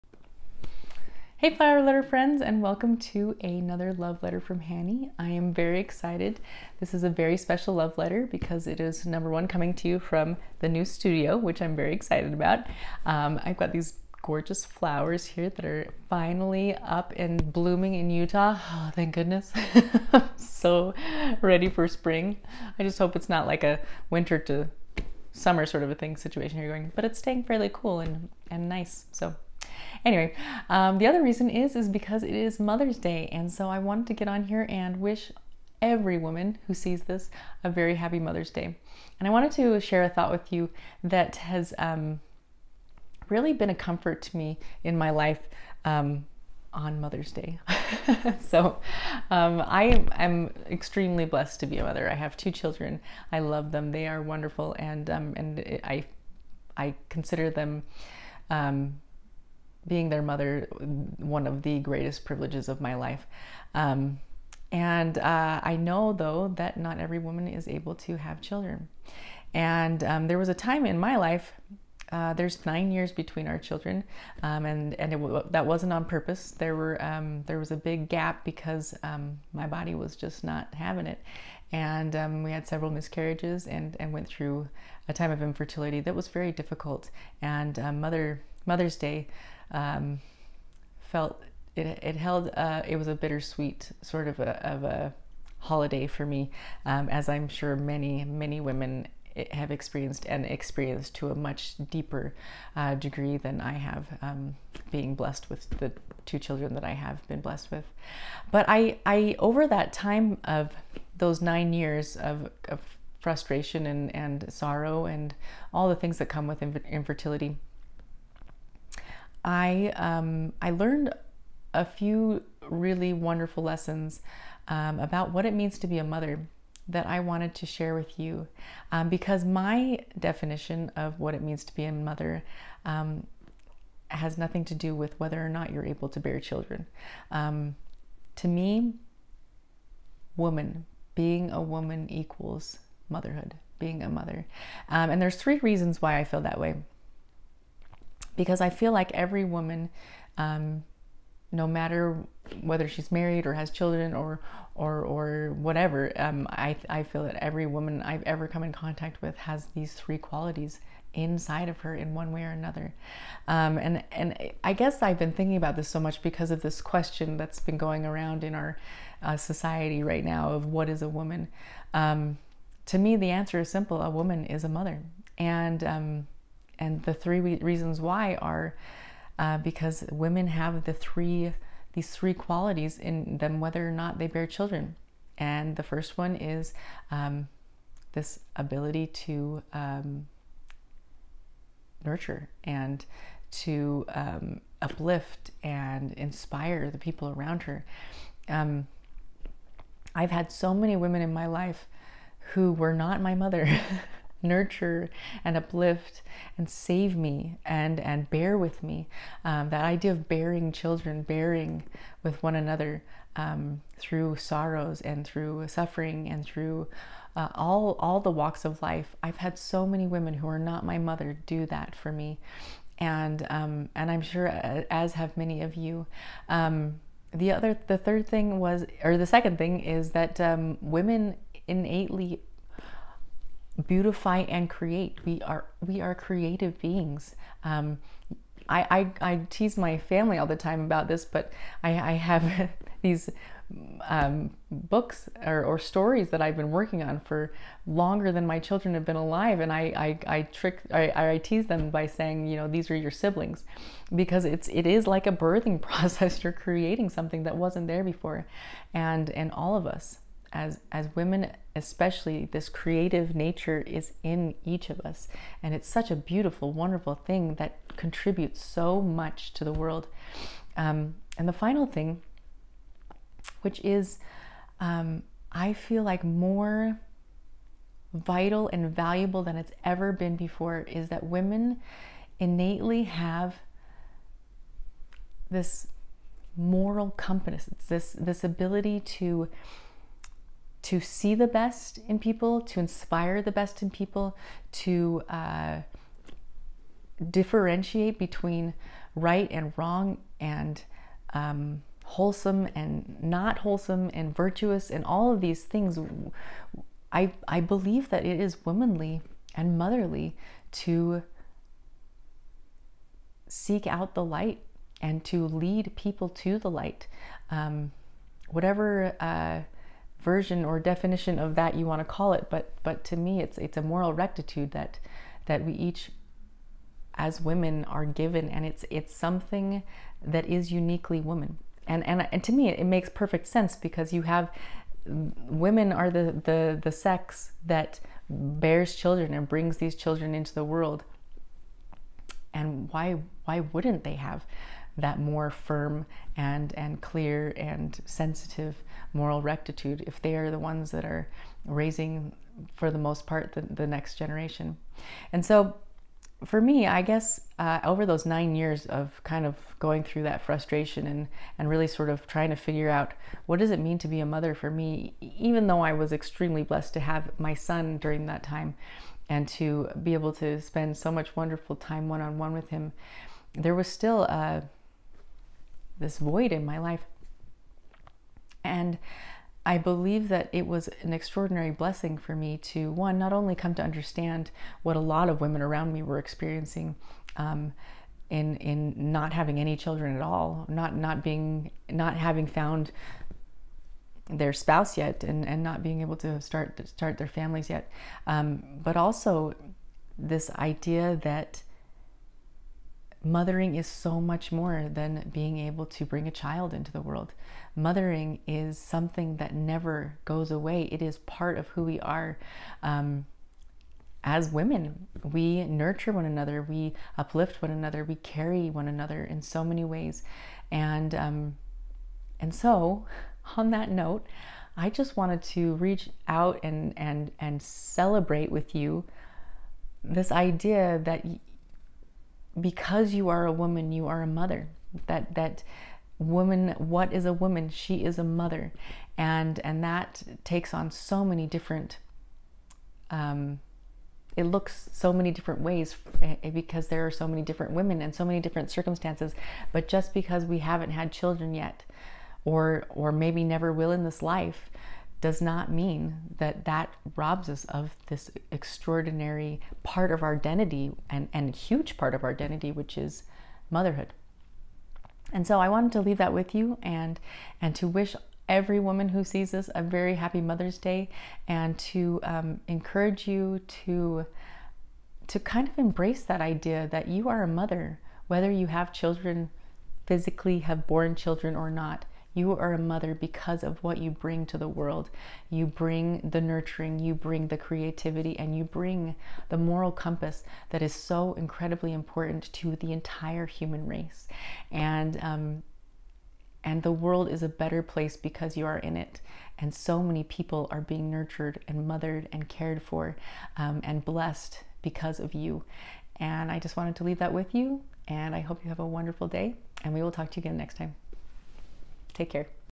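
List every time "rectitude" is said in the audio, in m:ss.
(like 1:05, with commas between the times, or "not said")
5:24, 5:49.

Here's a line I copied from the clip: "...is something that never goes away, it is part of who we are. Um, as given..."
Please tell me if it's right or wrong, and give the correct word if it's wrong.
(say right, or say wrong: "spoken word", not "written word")
wrong: "women", not "given".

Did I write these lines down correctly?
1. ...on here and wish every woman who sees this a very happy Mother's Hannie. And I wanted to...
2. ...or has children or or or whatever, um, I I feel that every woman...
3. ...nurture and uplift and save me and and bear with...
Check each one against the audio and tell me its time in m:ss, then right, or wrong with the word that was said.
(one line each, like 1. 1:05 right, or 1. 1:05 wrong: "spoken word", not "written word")
1. 0:34 wrong: "Day", not "Hannie"
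2. 2:33 right
3. 3:24 right.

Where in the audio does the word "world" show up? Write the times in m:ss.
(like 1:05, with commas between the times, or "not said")
4:29, 5:40, 6:47, 8:04, 8:16.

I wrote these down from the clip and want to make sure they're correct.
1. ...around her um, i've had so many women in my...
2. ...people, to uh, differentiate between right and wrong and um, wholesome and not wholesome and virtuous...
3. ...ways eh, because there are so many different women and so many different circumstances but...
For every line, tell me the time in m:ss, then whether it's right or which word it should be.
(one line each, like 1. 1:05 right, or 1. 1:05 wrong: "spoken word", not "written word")
1. 3:17 right
2. 4:53 right
3. 7:25 right.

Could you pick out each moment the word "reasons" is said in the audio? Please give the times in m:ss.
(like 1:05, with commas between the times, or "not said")
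0:31, 2:25, 2:57.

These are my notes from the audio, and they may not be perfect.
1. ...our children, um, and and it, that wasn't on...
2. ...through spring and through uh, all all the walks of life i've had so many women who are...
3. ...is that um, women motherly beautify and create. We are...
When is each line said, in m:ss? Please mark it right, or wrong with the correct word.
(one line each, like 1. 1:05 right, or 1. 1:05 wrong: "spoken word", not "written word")
1. 1:13 right
2. 3:35 wrong: "suffering", not "spring"
3. 3:49 wrong: "innately", not "motherly".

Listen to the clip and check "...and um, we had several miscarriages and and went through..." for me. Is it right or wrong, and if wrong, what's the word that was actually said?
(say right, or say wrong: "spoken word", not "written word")
right.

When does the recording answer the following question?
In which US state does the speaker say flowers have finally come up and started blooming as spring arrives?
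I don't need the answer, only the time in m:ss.
0:18.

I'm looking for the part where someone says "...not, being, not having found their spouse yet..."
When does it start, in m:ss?
6:30.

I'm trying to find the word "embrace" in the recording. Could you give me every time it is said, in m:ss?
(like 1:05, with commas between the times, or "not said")
7:55.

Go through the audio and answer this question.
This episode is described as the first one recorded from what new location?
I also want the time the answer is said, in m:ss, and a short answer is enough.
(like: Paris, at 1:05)
new studio, at 0:10.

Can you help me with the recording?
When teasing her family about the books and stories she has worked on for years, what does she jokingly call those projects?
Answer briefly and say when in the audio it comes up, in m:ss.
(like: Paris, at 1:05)
siblings, at 4:13.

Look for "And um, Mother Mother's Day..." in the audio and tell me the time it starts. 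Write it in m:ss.
1:27.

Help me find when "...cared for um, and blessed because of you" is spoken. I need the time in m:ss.
8:22.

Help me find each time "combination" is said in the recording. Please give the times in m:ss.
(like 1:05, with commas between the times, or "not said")
not said.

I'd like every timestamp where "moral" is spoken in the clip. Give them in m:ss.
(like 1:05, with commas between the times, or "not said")
4:46, 5:23, 5:49, 8:09.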